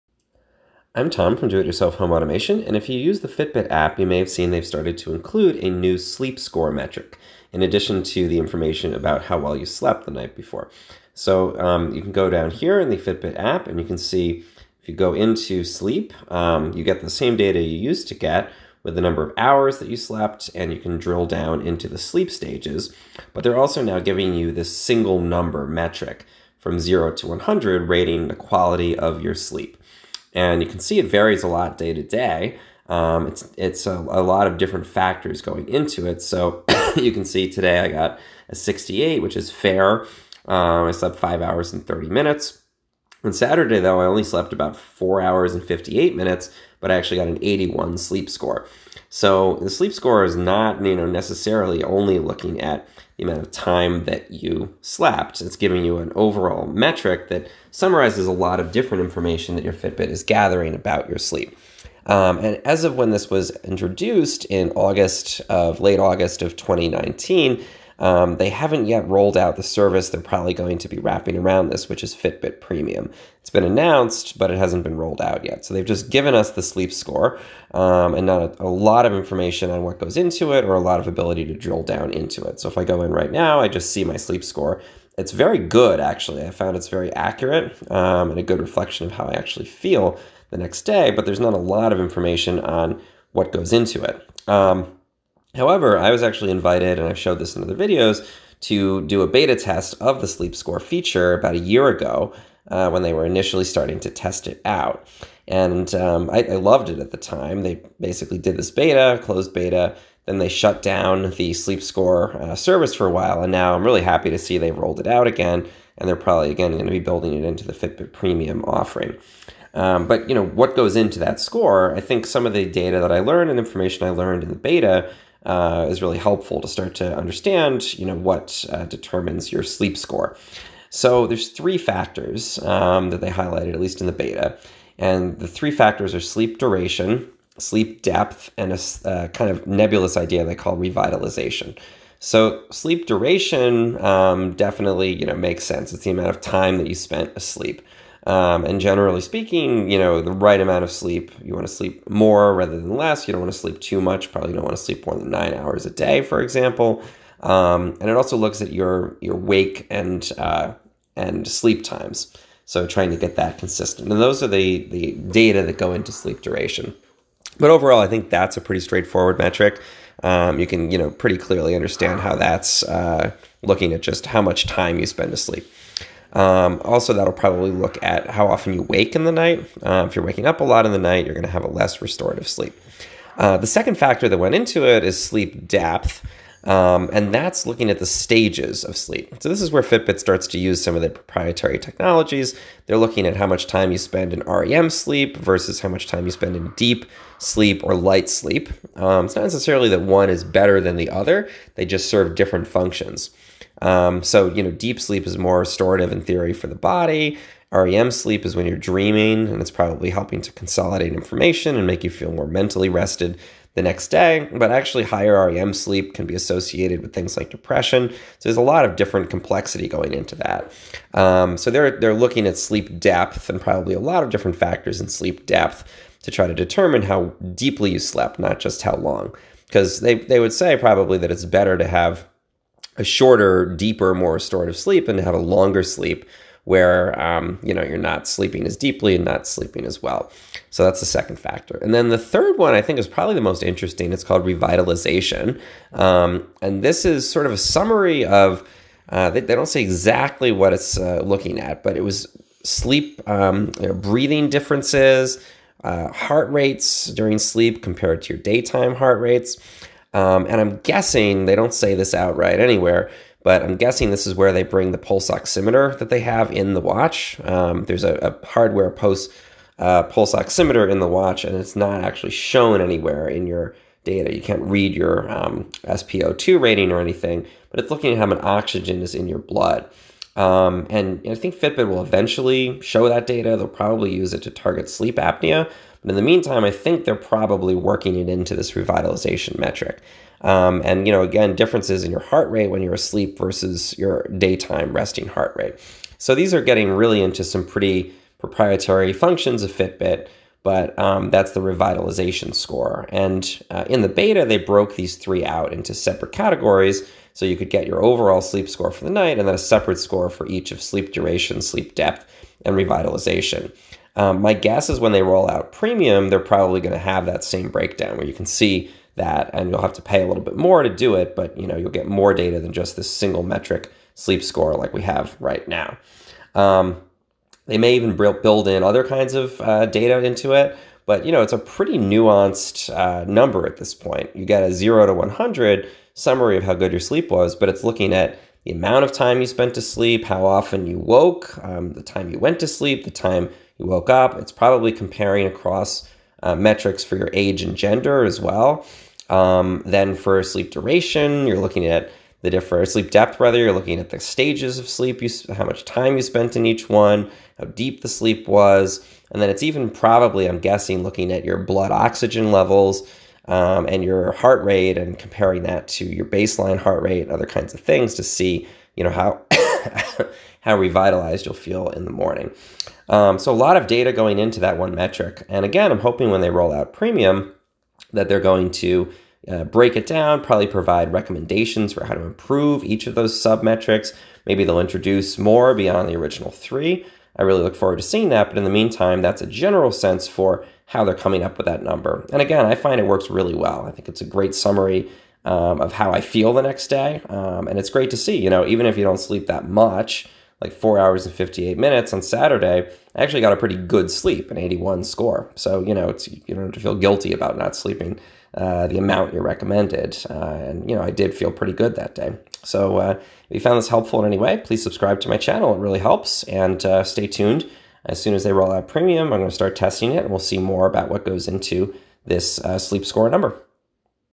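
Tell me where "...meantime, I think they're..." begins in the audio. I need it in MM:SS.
04:46.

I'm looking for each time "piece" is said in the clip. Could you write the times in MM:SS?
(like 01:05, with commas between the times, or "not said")
not said.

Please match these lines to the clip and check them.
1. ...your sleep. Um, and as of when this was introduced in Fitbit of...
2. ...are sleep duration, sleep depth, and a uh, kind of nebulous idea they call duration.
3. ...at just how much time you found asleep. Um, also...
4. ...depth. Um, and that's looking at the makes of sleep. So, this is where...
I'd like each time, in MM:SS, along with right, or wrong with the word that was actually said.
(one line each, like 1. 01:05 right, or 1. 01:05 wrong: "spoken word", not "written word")
1. 01:01 wrong: "August", not "Fitbit"
2. 02:16 wrong: "revitalization", not "duration"
3. 02:53 wrong: "spend", not "found"
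4. 03:05 wrong: "stages", not "makes".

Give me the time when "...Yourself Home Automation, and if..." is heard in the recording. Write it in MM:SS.
00:01.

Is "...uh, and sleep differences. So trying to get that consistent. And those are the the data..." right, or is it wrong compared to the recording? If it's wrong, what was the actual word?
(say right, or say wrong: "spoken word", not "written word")
wrong: "times", not "differences".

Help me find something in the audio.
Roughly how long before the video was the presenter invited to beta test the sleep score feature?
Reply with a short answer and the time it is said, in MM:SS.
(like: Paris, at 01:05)
a year ago, at 01:41.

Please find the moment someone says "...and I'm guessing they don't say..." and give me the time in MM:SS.
04:20.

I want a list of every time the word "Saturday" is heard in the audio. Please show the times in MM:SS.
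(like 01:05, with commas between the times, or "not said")
00:43, 06:42.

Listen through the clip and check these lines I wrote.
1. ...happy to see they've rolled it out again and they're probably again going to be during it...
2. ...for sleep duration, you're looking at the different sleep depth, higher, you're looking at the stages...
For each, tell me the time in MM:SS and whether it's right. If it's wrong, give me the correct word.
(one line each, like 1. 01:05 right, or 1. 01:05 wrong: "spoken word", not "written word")
1. 01:54 wrong: "building", not "during"
2. 05:50 wrong: "rather", not "higher".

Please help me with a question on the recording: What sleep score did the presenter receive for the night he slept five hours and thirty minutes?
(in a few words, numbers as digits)
68.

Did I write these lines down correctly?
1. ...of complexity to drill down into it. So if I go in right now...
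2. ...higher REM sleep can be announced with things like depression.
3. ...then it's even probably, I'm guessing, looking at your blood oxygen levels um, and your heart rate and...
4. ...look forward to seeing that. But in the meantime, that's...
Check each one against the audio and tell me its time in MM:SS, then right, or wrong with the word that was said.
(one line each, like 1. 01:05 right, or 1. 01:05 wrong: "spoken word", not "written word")
1. 01:20 wrong: "ability", not "complexity"
2. 03:35 wrong: "associated", not "announced"
3. 05:59 right
4. 06:27 right.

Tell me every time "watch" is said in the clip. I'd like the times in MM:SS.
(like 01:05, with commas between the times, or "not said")
04:26, 04:31.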